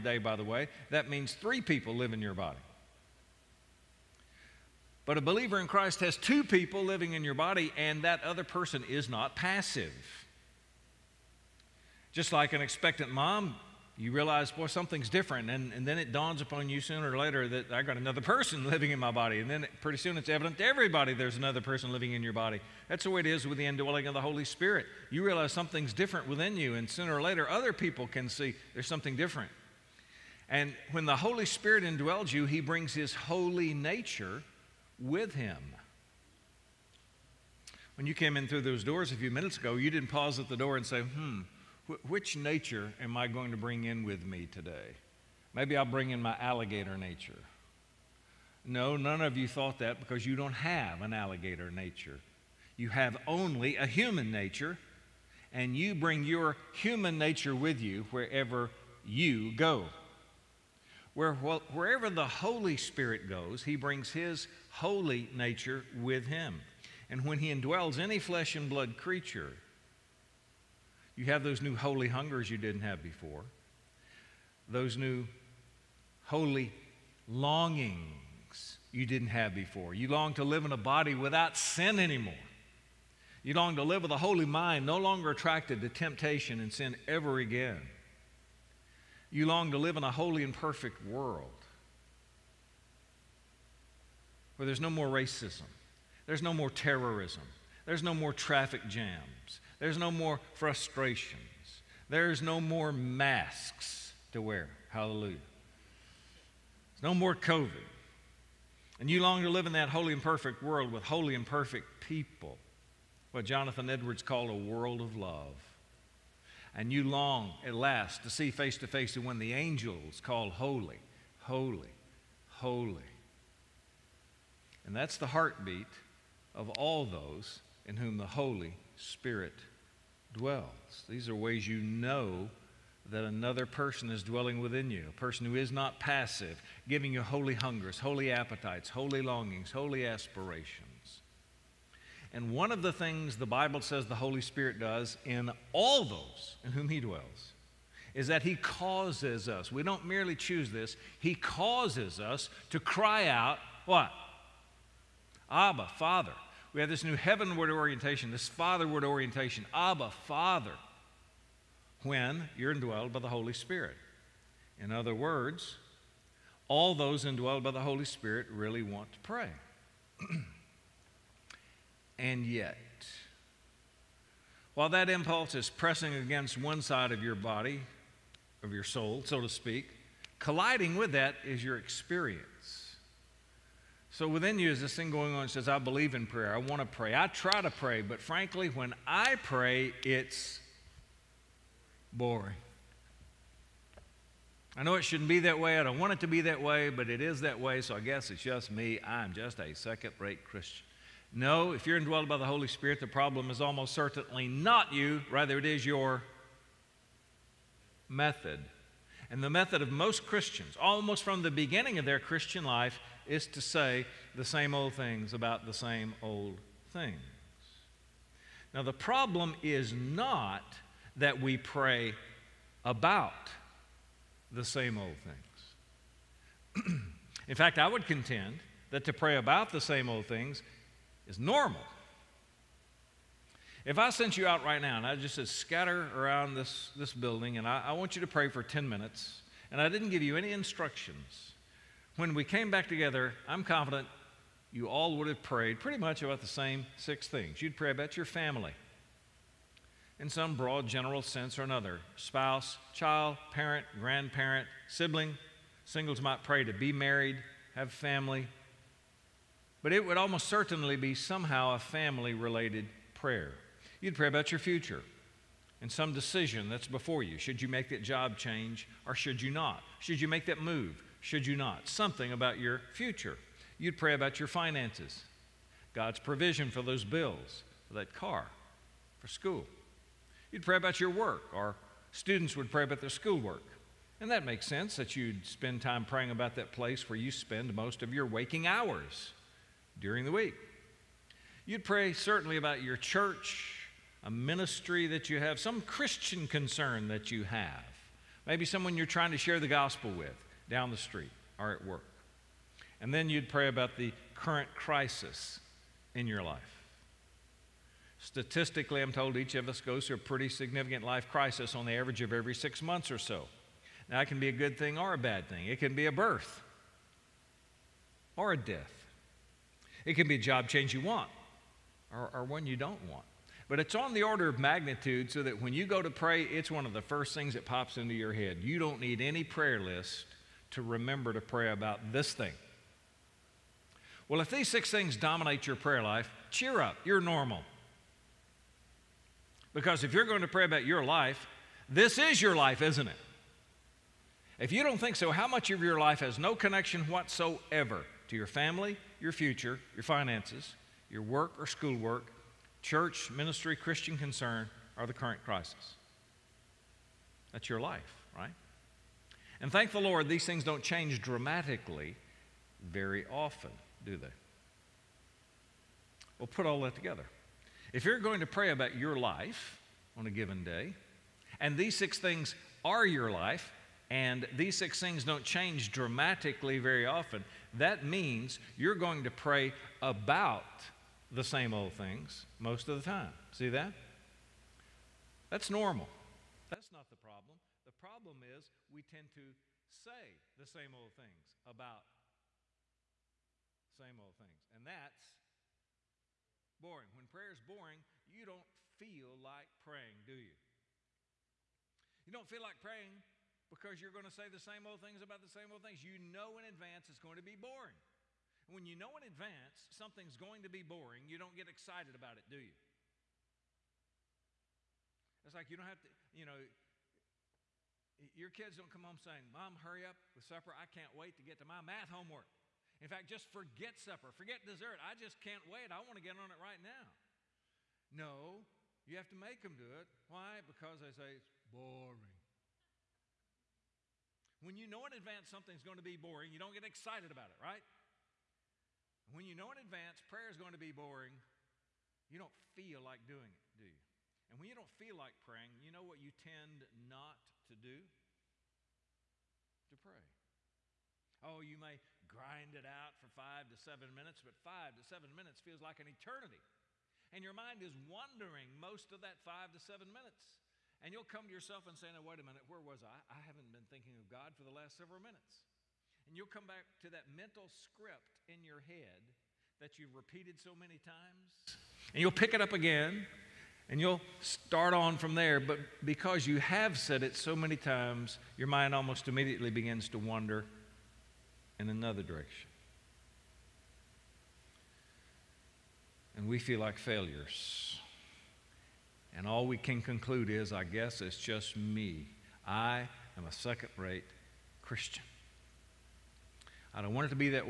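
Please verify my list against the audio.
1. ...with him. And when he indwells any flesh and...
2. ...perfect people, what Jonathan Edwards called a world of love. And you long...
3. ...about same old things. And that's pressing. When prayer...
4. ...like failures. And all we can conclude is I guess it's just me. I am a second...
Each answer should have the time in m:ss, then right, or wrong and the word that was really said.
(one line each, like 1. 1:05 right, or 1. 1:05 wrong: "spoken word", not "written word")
1. 1:05 right
2. 1:51 right
3. 6:31 wrong: "boring", not "pressing"
4. 8:06 right.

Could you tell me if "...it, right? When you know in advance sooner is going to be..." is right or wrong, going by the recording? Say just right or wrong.
wrong.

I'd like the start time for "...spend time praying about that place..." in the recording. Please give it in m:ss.
4:45.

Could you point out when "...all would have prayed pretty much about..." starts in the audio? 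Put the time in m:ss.
4:04.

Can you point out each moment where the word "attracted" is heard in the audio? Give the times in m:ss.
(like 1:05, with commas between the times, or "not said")
1:25.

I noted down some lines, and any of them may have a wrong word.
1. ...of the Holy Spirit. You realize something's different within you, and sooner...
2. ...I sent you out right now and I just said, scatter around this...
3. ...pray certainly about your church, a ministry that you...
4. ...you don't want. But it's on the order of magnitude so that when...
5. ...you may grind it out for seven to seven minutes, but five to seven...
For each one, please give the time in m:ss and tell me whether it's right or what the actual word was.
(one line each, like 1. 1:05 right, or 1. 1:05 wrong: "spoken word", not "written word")
1. 0:24 right
2. 3:53 right
3. 4:51 right
4. 5:22 right
5. 7:31 wrong: "five", not "seven".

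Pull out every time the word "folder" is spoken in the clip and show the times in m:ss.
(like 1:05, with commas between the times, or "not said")
not said.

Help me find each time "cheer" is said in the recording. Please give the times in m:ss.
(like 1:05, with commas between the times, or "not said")
5:36.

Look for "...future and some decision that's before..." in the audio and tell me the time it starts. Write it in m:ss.
4:24.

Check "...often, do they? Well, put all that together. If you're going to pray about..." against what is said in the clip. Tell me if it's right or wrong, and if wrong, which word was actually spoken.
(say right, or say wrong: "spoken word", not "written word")
right.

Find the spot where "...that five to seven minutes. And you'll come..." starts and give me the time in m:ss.
7:39.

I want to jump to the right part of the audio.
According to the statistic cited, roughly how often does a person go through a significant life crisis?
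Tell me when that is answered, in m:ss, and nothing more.
5:12.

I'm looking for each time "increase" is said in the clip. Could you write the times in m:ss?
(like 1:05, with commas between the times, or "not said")
not said.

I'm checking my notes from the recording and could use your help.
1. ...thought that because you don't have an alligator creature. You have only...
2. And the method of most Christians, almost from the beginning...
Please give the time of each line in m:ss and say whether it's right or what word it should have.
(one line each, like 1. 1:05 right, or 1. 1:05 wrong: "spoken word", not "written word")
1. 0:49 wrong: "nature", not "creature"
2. 3:29 right.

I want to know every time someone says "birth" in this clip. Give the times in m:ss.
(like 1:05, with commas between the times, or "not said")
5:16.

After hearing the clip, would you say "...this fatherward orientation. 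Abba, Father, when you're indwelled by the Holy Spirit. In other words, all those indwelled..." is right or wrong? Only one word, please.
right.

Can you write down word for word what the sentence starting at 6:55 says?
It's like you don't have to, you know, your kids don't come home saying, Mom, hurry up with supper.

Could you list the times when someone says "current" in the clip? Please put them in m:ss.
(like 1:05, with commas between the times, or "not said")
5:04, 5:55.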